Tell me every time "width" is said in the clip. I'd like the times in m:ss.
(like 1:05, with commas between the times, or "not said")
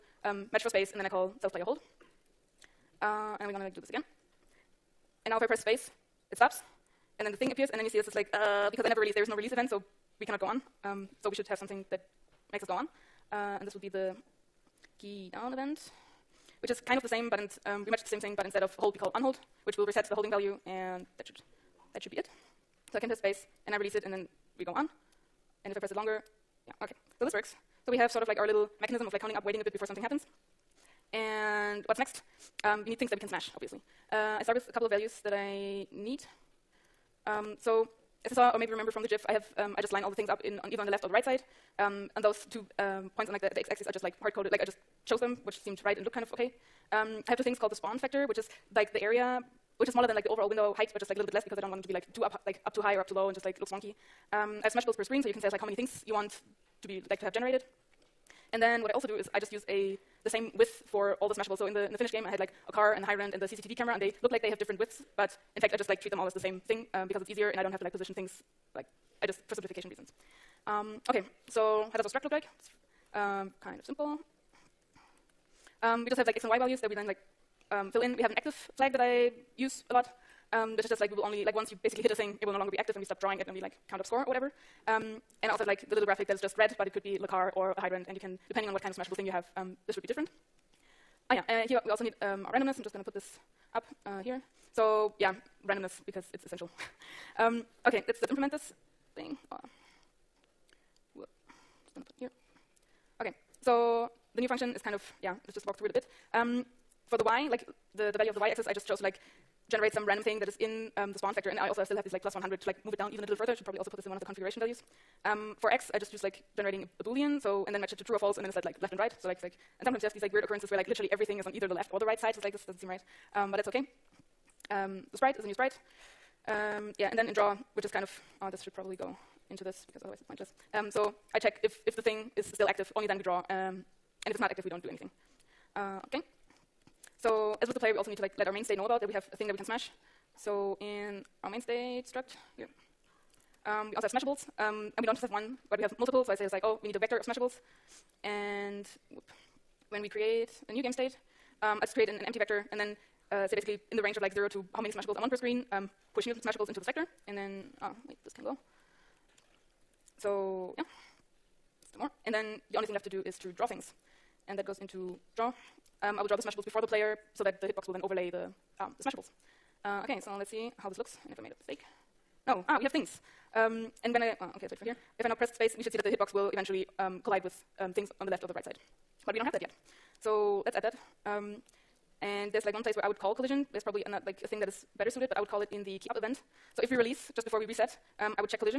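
1:00, 1:04.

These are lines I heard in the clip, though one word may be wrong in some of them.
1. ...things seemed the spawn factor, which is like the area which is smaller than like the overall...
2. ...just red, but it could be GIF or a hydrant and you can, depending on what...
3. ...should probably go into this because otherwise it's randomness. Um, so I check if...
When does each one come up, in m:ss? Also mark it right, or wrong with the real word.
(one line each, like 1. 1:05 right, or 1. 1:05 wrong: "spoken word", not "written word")
1. 0:47 wrong: "called", not "seemed"
2. 1:26 wrong: "Lacar", not "GIF"
3. 2:08 wrong: "pointless", not "randomness".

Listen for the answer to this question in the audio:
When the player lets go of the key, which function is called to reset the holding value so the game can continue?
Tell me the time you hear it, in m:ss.
0:19.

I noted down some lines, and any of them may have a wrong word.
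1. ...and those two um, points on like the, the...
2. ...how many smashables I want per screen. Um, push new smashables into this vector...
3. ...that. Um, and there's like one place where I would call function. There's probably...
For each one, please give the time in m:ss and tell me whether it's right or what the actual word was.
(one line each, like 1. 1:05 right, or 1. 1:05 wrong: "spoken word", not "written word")
1. 0:42 right
2. 2:34 right
3. 3:00 wrong: "collision", not "function".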